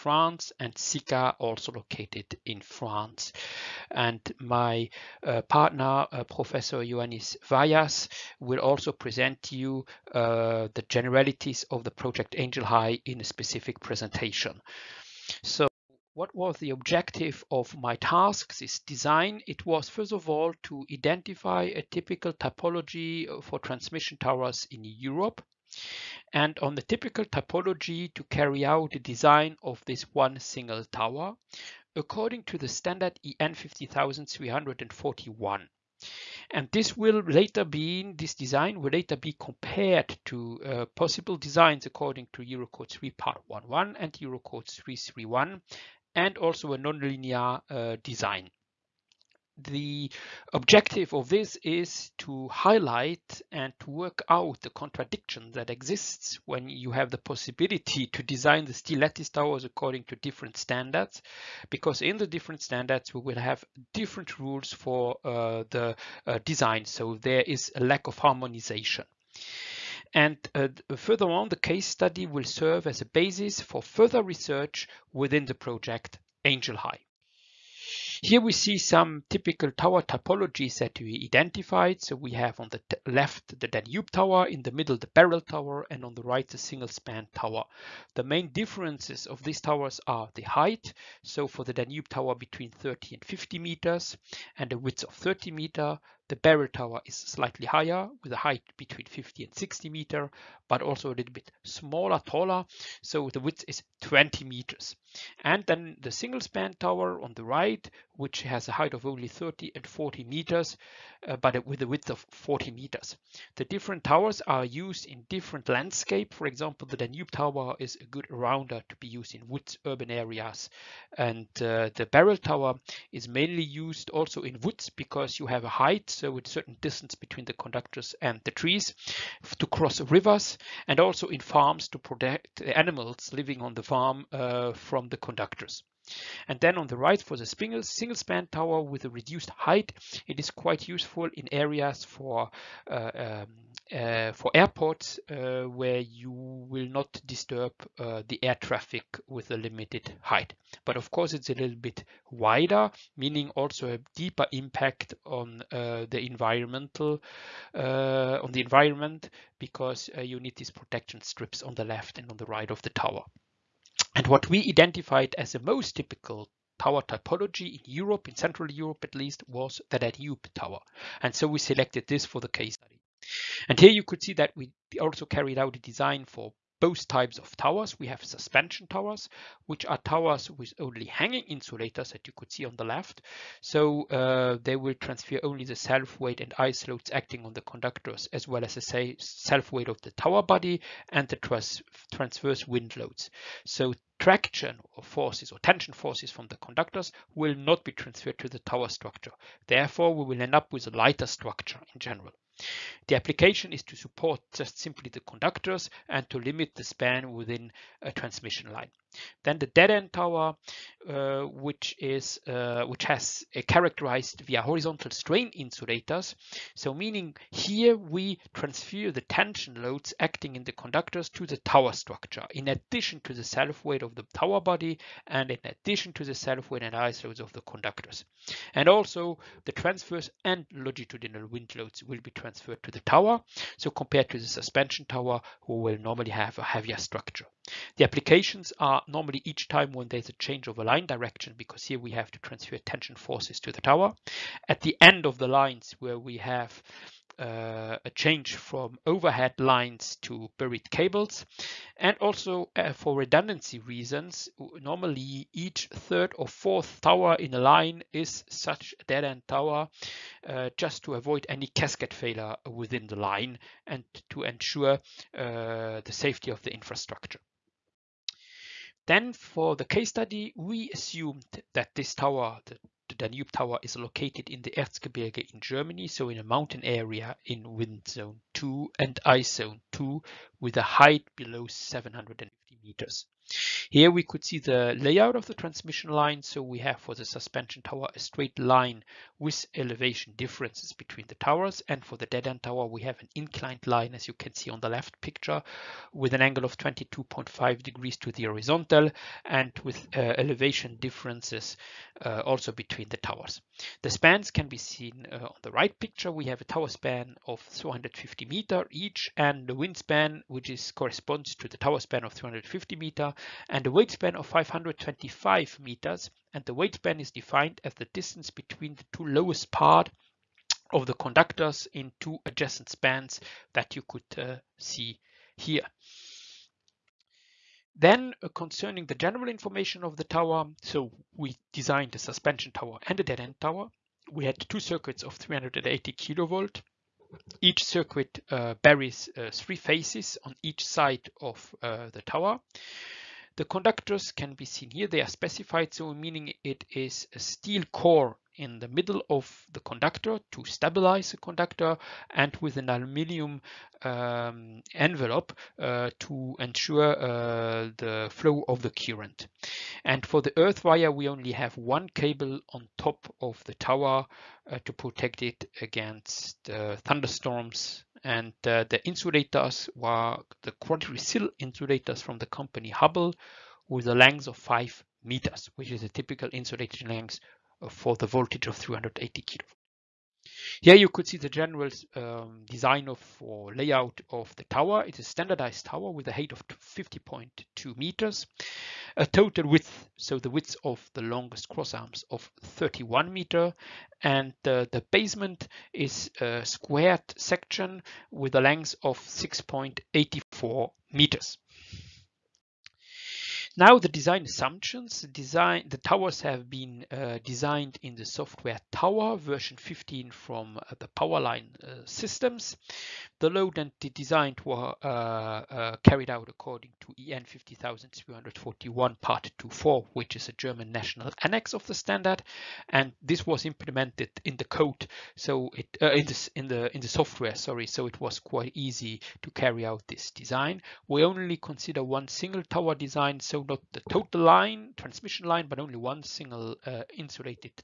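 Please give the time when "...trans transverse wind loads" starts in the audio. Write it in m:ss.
3:11.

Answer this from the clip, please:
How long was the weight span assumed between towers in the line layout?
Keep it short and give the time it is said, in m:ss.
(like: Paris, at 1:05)
525 meters, at 5:14.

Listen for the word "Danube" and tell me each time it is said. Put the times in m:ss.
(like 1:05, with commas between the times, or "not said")
1:23, 1:31, 1:56, 2:49, 4:33.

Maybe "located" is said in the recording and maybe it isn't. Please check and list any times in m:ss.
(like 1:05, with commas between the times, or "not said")
0:01, 4:33.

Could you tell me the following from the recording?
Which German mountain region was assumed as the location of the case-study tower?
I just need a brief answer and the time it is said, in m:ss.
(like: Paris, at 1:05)
Erzgebirge, at 4:34.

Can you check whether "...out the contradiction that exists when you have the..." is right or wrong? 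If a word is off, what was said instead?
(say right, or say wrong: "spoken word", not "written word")
right.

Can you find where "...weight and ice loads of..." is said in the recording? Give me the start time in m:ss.
3:46.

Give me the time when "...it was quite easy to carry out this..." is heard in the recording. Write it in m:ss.
7:08.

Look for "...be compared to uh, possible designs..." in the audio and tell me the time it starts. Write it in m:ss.
0:39.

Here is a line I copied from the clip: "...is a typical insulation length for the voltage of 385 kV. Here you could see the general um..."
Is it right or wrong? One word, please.
wrong.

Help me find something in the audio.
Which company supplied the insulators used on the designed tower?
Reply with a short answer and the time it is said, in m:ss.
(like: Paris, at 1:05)
Hubbell, at 6:12.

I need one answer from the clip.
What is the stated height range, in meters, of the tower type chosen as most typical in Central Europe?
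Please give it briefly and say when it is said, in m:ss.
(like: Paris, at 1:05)
30 to 50 meters, at 1:32.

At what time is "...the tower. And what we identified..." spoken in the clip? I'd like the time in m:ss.
2:42.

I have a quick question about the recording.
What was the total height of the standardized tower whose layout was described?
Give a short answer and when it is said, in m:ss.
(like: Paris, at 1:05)
50.2 meters, at 6:26.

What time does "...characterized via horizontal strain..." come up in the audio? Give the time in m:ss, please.
3:33.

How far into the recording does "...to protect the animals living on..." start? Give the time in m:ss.
2:11.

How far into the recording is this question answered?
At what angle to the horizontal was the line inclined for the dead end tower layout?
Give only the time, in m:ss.
4:56.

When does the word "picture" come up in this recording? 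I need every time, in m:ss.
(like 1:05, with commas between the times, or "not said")
4:55, 5:06.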